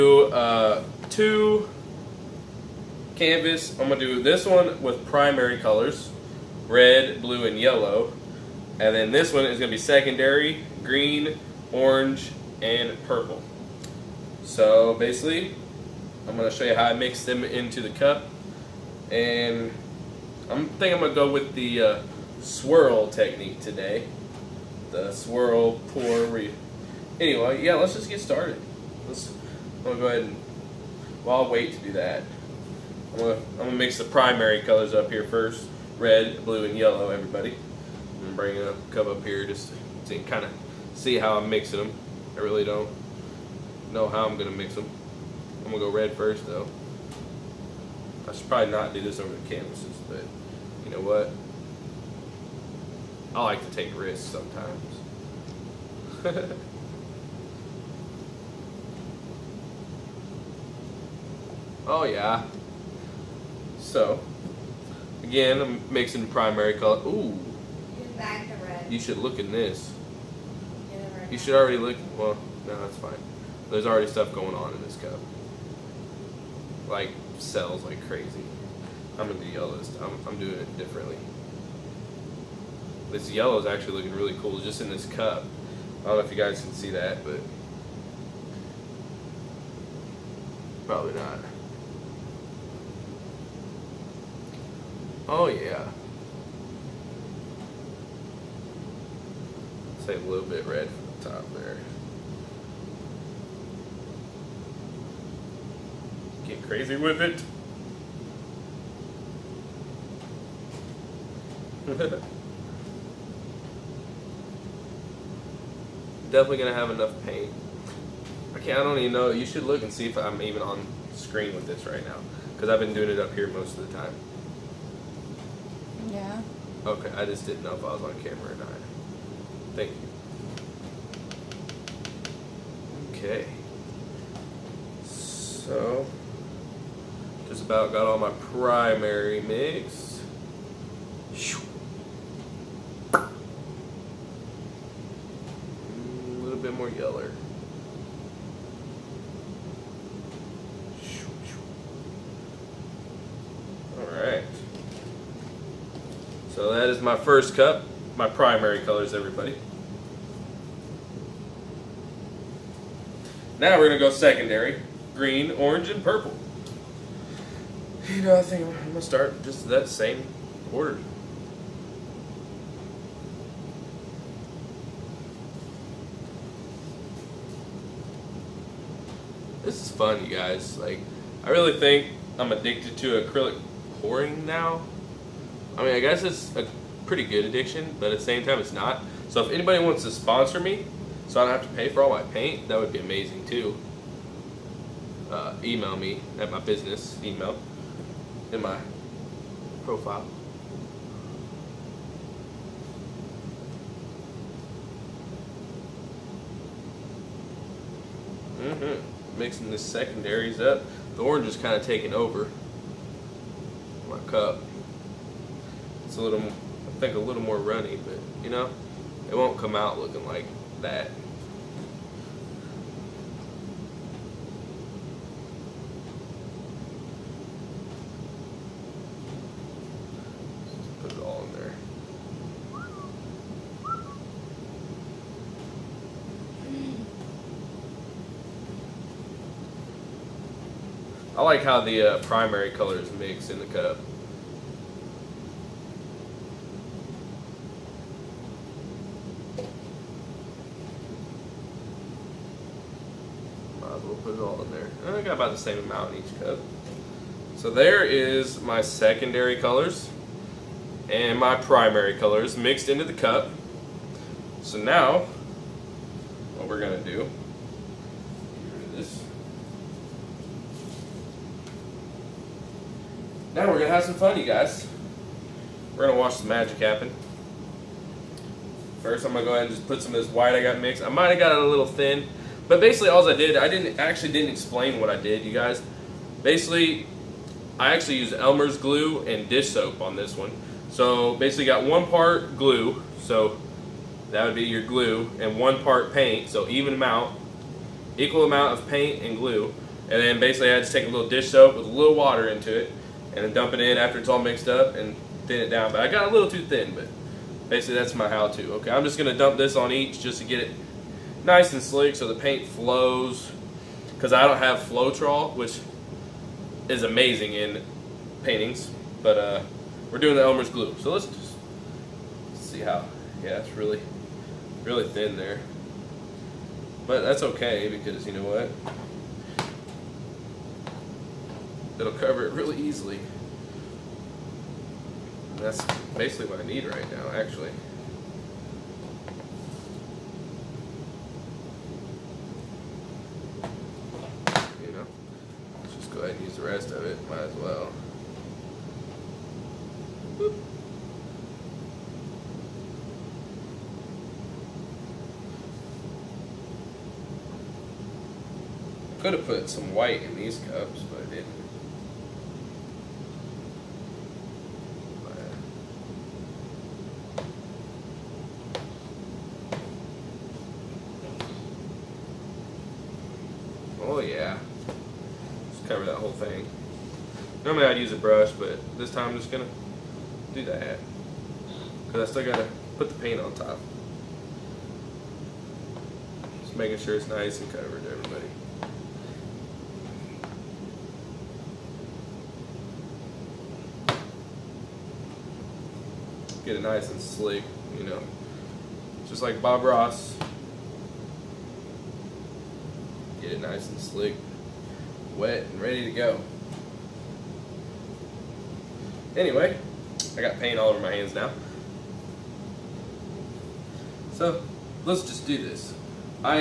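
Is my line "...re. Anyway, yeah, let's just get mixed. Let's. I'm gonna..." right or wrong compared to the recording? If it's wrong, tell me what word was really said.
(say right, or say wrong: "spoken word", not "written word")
wrong: "started", not "mixed".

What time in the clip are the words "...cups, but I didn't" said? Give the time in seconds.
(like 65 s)
360 s.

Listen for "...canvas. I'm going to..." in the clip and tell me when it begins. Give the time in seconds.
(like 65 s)
3 s.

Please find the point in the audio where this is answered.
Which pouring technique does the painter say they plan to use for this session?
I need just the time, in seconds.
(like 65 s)
22 s.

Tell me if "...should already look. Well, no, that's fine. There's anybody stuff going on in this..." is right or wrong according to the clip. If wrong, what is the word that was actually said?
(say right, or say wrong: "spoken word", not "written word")
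wrong: "already", not "anybody".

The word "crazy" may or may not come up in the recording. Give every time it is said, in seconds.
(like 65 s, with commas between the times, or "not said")
78 s, 106 s.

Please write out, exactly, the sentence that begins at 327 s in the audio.
But that's okay because you know what?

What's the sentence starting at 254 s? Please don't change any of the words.
We'll put it all in there.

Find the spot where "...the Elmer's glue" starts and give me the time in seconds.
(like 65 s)
320 s.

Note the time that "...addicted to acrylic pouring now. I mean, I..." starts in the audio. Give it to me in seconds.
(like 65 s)
182 s.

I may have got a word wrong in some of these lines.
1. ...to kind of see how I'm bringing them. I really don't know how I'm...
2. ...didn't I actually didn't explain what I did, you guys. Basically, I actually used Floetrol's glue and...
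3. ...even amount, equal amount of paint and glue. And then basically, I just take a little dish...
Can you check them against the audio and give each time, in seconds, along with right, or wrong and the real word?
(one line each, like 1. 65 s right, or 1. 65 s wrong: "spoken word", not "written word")
1. 40 s wrong: "mixing", not "bringing"
2. 283 s wrong: "Elmer", not "Floetrol"
3. 296 s right.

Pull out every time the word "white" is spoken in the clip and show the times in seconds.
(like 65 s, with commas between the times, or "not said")
280 s, 359 s.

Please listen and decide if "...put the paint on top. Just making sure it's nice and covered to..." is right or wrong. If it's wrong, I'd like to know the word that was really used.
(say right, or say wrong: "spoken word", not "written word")
right.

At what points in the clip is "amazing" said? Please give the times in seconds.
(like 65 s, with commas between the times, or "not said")
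192 s, 317 s.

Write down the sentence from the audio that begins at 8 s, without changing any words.
And then this one is going to be secondary, green, orange, and purple.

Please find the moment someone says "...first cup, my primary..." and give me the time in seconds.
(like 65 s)
157 s.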